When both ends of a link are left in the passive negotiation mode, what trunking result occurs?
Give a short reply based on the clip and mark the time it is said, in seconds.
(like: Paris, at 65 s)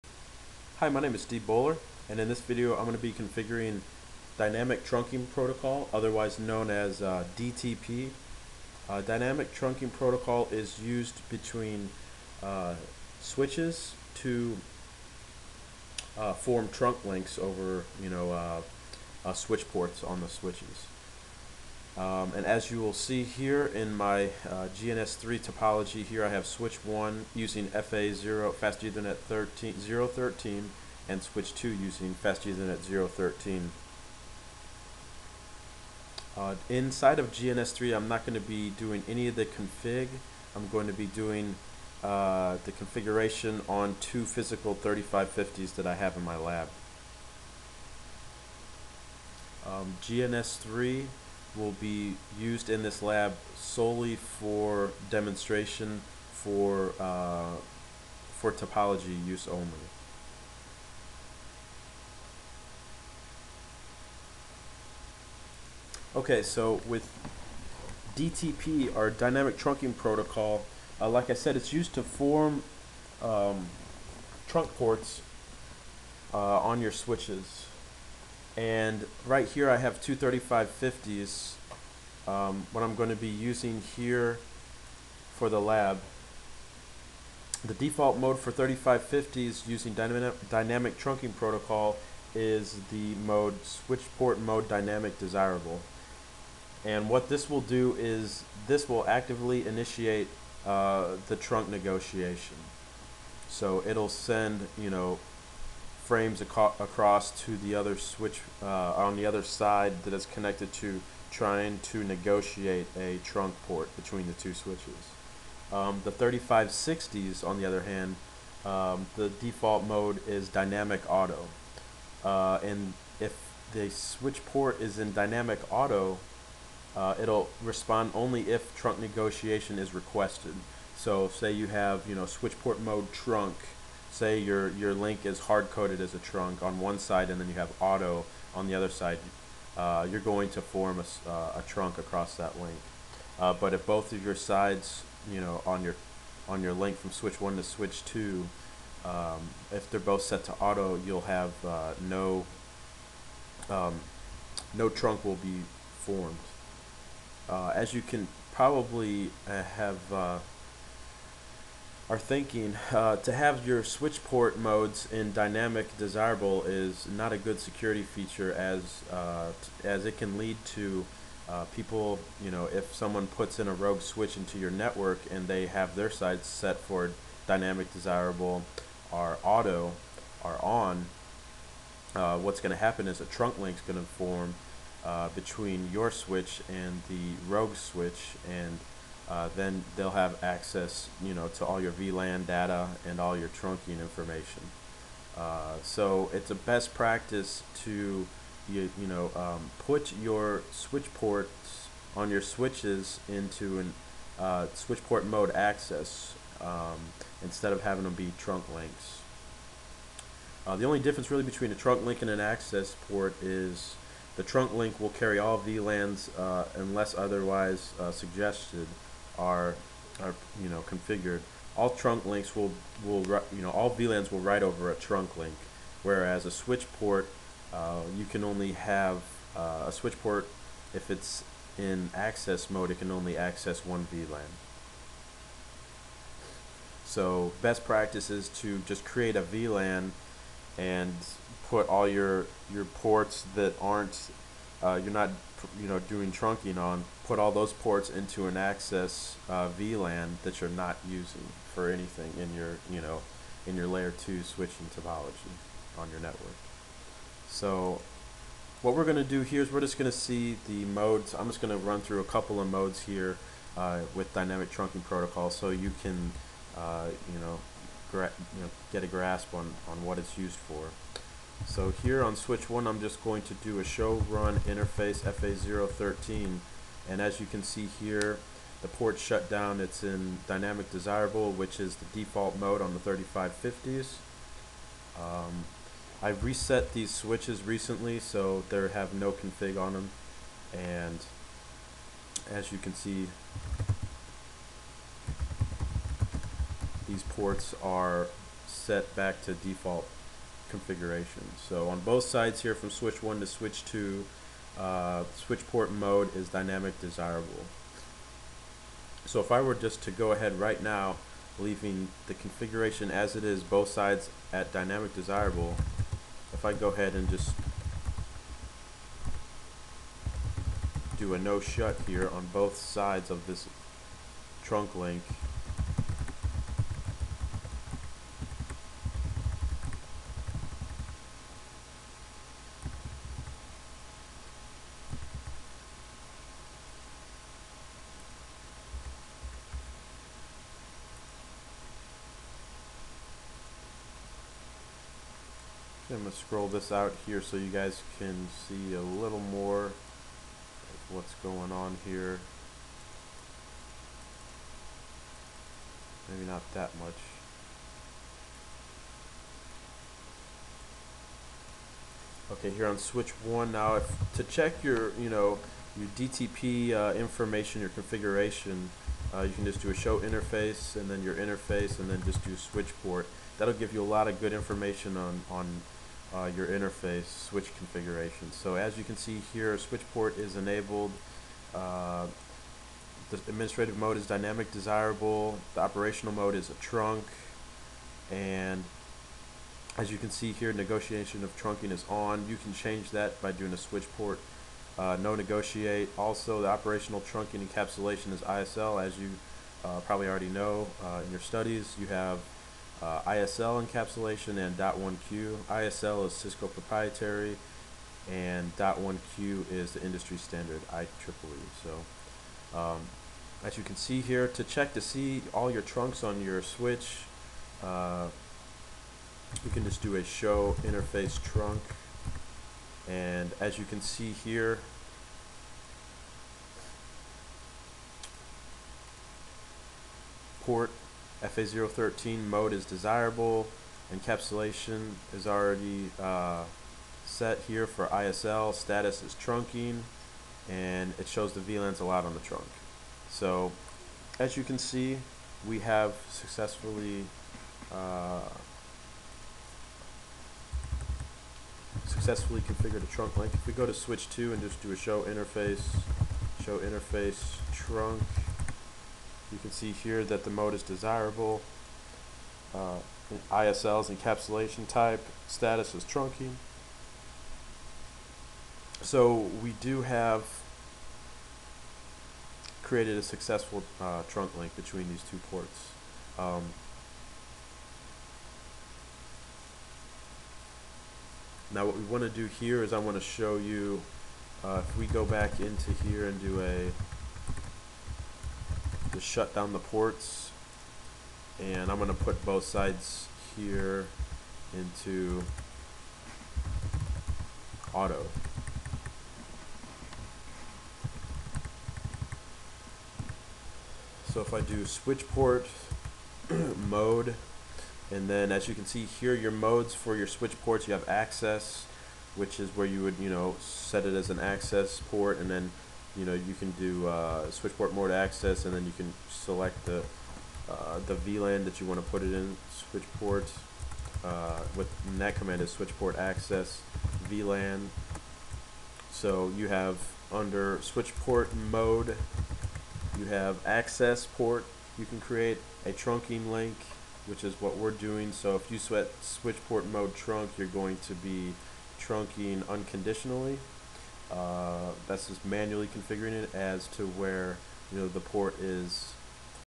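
no trunk, at 154 s.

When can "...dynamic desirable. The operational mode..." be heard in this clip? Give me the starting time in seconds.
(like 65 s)
384 s.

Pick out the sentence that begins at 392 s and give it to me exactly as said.
You can change that by doing a switch port.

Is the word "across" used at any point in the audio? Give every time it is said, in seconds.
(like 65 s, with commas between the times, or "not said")
106 s, 141 s.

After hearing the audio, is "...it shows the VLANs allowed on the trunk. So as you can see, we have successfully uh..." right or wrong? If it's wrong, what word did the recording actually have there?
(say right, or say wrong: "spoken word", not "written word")
right.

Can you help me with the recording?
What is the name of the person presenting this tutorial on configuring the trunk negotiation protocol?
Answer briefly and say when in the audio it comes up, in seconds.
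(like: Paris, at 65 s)
Steve Bowler, at 1 s.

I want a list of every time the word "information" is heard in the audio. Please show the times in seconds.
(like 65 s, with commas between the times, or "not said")
193 s, 367 s, 374 s.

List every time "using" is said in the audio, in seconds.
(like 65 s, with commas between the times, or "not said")
27 s, 31 s, 83 s, 89 s, 251 s.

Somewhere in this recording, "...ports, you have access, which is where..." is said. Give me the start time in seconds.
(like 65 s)
510 s.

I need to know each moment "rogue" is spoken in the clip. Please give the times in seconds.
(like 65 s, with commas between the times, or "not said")
173 s, 187 s.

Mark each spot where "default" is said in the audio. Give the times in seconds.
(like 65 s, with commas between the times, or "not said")
87 s, 119 s, 282 s, 299 s.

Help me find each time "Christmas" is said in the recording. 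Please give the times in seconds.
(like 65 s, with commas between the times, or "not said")
not said.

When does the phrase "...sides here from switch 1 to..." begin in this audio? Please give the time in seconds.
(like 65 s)
302 s.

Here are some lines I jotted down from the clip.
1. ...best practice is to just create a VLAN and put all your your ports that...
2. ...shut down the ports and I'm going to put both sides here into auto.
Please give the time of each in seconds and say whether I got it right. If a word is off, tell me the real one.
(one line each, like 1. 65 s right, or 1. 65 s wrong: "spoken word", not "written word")
1. 237 s right
2. 489 s right.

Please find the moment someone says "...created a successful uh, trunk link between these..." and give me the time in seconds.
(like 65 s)
472 s.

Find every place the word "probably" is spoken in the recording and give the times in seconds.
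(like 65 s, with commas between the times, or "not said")
158 s, 400 s.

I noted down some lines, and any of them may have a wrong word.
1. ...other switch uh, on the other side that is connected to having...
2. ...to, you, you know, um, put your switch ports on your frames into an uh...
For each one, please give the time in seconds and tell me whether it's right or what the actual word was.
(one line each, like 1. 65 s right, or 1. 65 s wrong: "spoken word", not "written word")
1. 107 s wrong: "trying", not "having"
2. 197 s wrong: "switches", not "frames".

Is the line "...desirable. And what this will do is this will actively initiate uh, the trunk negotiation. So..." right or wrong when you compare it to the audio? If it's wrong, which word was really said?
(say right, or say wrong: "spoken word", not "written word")
right.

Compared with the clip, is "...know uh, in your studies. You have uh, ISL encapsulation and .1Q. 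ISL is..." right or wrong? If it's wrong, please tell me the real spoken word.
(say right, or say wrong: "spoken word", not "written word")
right.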